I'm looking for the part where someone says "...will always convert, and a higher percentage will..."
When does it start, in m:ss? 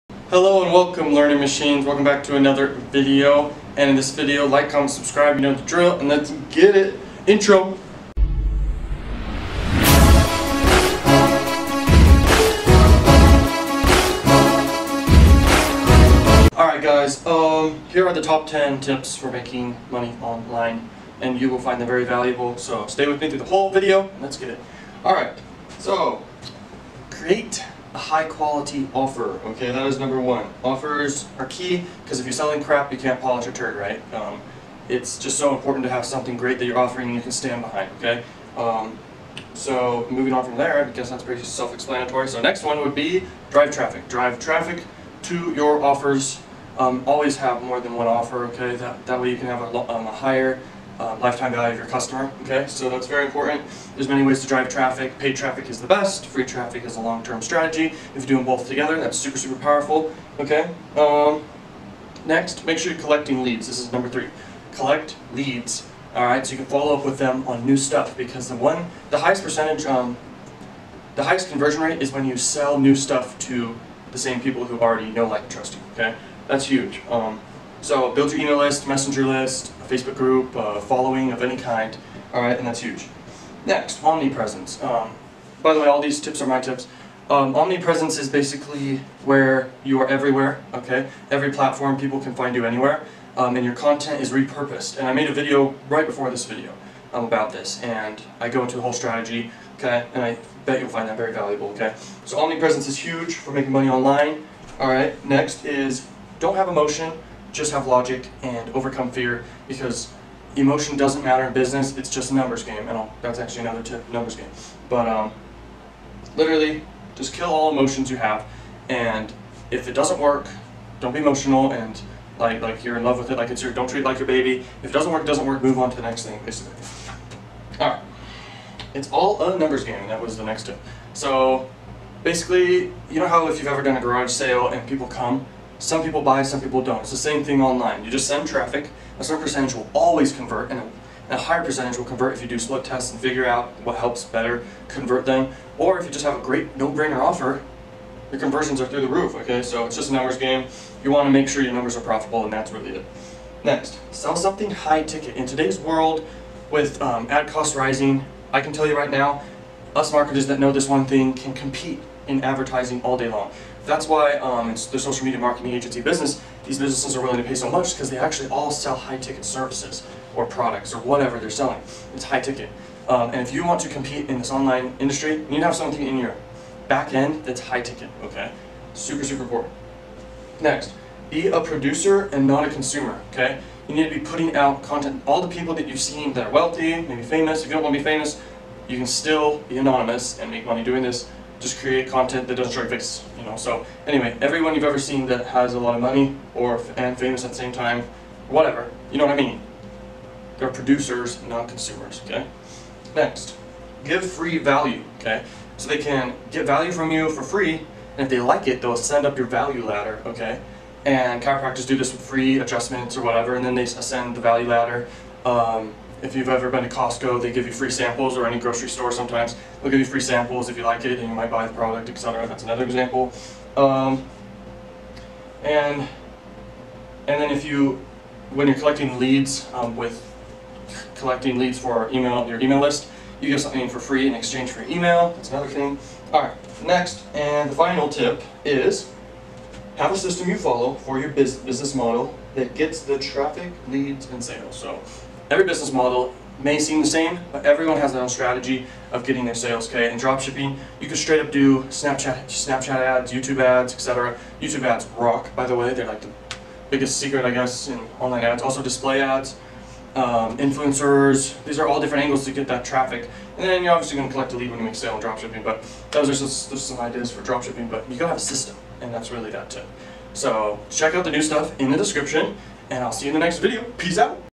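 2:19.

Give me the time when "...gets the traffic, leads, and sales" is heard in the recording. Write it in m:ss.
4:02.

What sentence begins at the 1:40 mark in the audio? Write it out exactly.
And I bet you'll find that very valuable, okay?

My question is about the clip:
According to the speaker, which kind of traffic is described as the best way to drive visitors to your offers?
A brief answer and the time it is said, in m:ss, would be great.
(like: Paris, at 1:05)
Paid traffic, at 0:55.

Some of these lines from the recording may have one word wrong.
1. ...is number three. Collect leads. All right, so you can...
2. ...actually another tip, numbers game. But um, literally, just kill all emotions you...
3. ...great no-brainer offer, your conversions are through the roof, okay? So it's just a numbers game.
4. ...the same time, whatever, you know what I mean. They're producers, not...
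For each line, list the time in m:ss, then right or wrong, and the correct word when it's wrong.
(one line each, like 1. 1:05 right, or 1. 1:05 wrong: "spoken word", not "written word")
1. 1:03 right
2. 1:53 right
3. 2:26 right
4. 3:17 right.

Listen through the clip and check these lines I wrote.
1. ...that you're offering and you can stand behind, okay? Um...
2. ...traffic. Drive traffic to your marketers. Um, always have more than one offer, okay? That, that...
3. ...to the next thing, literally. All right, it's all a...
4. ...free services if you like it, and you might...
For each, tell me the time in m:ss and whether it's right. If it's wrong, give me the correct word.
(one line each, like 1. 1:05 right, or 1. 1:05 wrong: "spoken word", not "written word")
1. 0:36 right
2. 0:43 wrong: "offers", not "marketers"
3. 2:05 wrong: "basically", not "literally"
4. 3:40 wrong: "samples", not "services".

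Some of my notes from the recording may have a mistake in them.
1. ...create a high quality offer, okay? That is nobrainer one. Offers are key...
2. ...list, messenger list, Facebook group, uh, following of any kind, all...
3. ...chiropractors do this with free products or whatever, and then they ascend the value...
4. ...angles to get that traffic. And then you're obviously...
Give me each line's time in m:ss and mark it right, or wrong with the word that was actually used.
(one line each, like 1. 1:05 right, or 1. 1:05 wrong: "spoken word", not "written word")
1. 0:27 wrong: "number", not "nobrainer"
2. 1:18 right
3. 3:31 wrong: "adjustments", not "products"
4. 4:22 right.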